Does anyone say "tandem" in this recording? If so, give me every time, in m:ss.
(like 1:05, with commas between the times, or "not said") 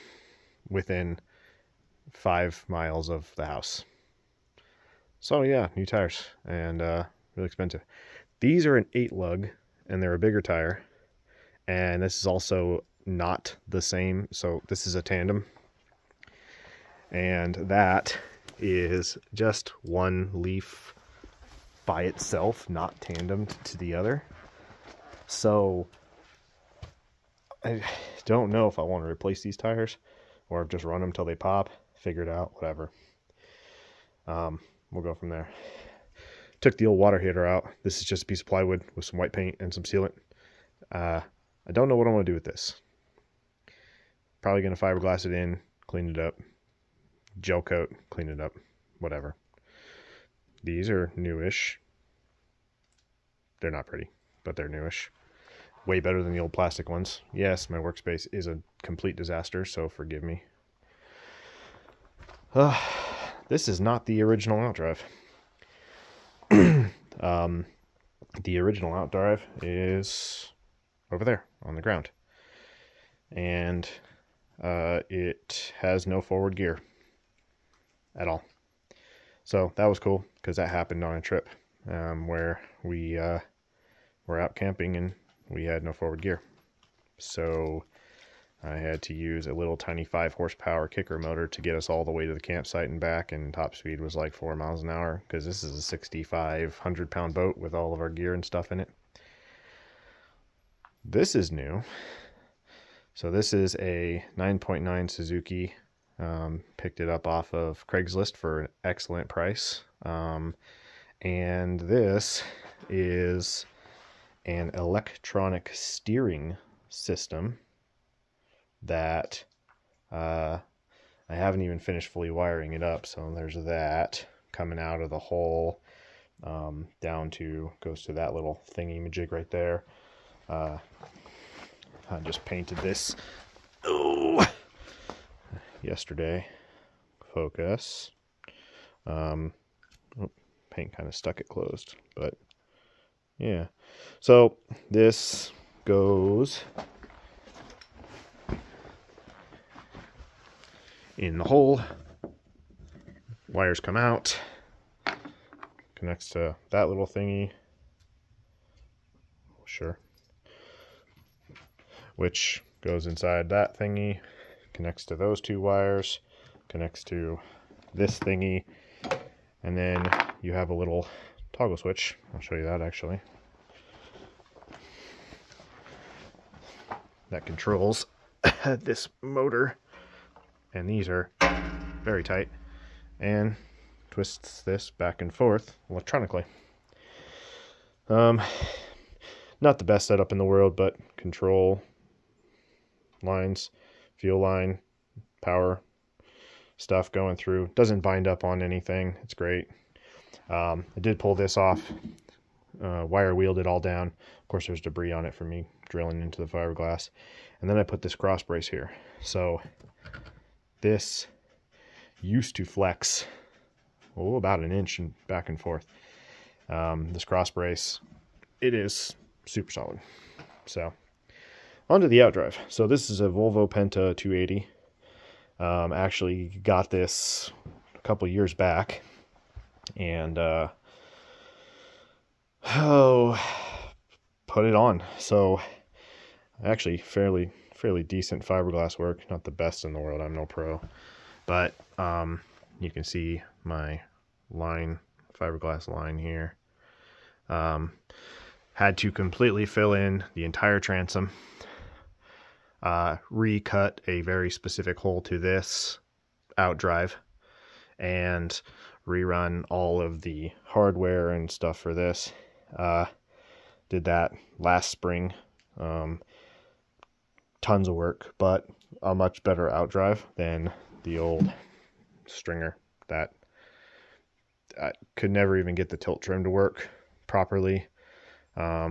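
0:15, 0:23.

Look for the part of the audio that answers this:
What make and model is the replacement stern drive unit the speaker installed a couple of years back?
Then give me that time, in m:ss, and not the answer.
3:43.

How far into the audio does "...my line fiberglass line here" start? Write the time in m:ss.
4:03.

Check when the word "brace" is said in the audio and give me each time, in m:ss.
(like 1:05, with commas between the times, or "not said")
3:28, 3:37.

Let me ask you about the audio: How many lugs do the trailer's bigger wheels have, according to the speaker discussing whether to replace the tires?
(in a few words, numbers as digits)
8.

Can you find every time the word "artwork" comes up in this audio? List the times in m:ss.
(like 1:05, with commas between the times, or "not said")
not said.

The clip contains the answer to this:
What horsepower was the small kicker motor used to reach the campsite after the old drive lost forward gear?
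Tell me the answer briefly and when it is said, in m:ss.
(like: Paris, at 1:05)
5, at 1:30.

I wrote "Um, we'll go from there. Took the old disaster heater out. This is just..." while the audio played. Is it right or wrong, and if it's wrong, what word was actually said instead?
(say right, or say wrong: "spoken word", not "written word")
wrong: "water", not "disaster".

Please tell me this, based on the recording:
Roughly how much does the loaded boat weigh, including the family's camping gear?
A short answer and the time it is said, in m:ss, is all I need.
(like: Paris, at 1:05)
6,500 pounds, at 1:35.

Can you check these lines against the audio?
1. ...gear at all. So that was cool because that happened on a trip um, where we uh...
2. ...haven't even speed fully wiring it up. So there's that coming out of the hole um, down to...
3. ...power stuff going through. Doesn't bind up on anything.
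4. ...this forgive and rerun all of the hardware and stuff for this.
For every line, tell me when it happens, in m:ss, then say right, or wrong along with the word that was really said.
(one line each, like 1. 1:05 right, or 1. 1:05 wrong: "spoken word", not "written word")
1. 1:16 right
2. 2:01 wrong: "finished", not "speed"
3. 3:15 right
4. 4:15 wrong: "outdrive", not "forgive".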